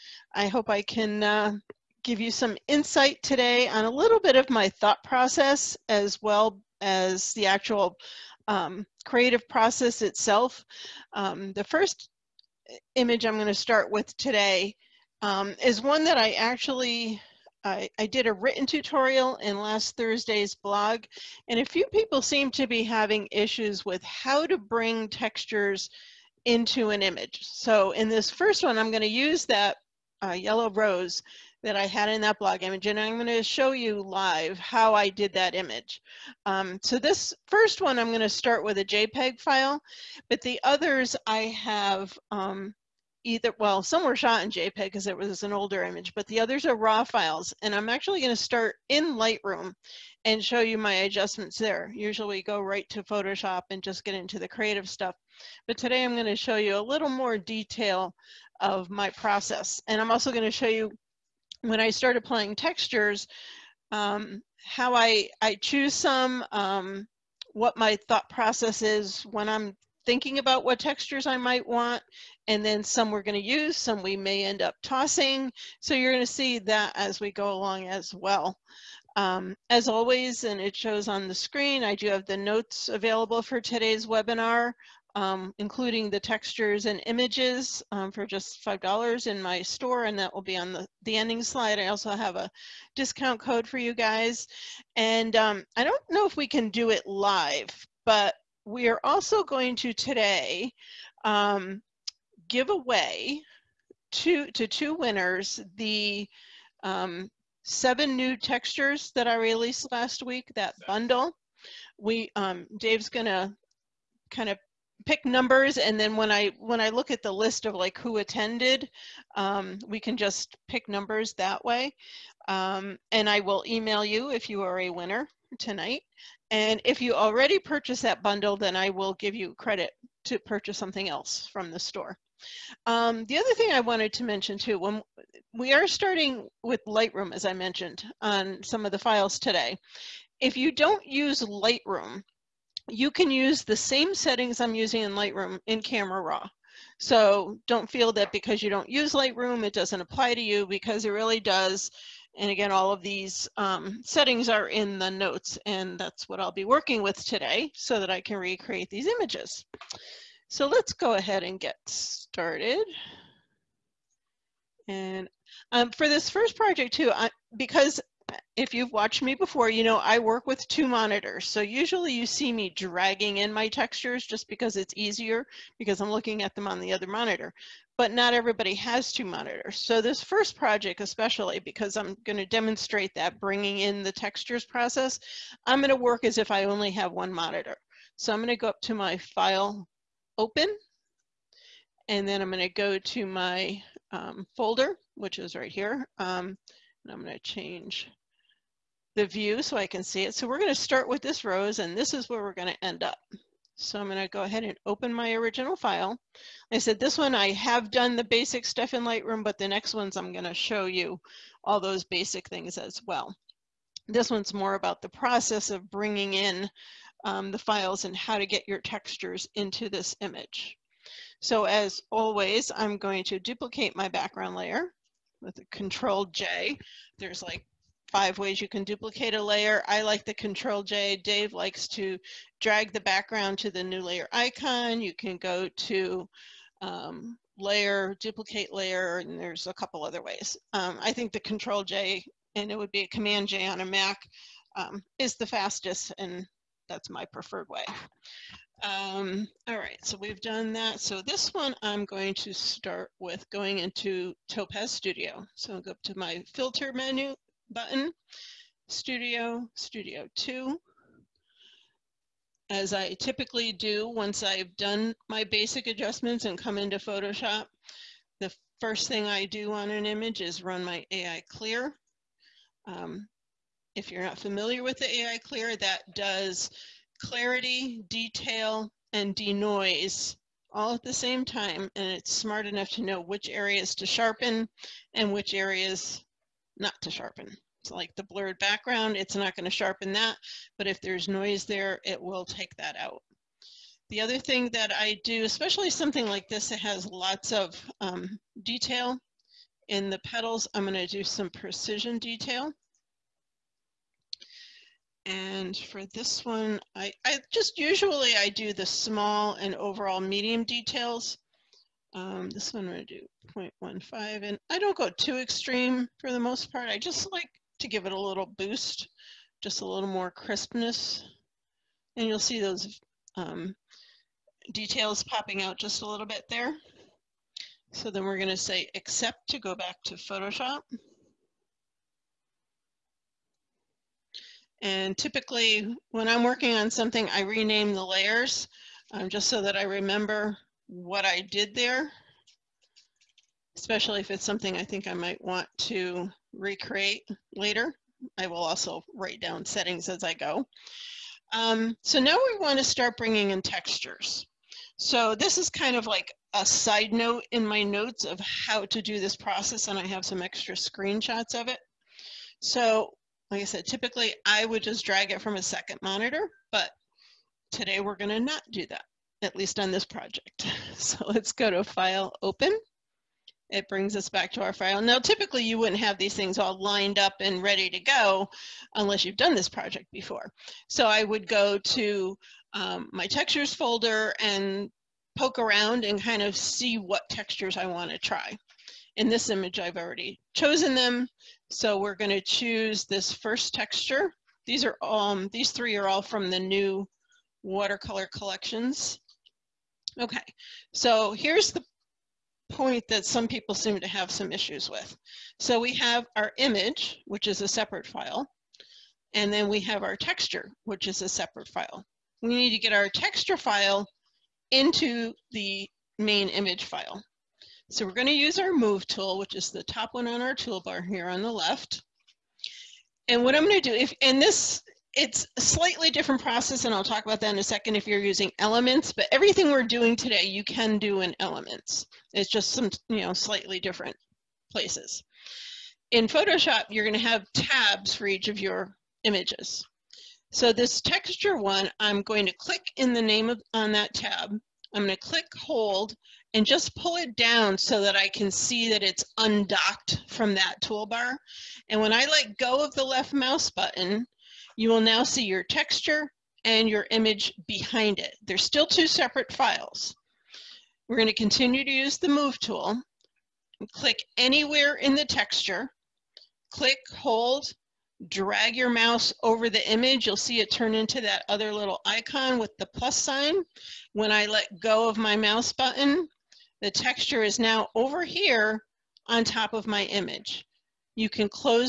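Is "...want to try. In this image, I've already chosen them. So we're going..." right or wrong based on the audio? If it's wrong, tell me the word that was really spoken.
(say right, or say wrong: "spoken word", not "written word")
right.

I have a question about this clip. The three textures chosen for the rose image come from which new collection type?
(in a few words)
Watercolor.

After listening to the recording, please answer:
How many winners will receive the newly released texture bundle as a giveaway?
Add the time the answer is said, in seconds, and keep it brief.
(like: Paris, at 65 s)
2, at 104 s.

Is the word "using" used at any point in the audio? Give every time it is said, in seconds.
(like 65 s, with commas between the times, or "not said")
144 s, 428 s.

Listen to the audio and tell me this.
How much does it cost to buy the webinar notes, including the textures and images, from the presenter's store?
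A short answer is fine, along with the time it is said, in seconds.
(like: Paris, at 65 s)
$5, at 88 s.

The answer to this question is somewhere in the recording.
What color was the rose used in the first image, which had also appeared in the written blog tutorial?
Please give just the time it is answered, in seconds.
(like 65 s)
30 s.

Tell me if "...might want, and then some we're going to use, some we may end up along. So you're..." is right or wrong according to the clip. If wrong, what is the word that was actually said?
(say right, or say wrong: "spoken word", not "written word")
wrong: "tossing", not "along".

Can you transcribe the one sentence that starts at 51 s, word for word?
Usually go right to Photoshop and just get into the creative stuff.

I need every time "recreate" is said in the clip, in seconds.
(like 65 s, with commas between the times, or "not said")
158 s, 346 s.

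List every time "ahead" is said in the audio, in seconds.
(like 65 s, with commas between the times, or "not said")
161 s, 204 s.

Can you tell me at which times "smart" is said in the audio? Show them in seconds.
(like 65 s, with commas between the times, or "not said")
282 s.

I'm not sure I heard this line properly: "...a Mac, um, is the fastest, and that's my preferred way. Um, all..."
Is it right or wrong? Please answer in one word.
right.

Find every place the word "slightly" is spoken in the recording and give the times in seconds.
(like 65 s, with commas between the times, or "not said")
425 s, 433 s.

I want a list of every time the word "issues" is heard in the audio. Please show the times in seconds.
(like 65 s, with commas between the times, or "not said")
23 s, 404 s.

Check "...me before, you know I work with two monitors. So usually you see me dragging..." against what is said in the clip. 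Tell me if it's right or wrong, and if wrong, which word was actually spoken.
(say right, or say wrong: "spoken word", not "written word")
right.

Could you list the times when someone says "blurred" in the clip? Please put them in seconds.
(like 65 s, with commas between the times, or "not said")
288 s.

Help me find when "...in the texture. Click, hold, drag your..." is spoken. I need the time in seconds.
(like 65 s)
464 s.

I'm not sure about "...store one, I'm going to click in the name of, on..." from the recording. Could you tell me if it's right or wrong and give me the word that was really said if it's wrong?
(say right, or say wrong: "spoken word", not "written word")
wrong: "texture", not "store".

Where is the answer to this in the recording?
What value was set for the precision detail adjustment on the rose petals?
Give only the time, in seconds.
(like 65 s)
313 s.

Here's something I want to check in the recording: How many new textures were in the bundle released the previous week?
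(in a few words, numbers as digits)
7.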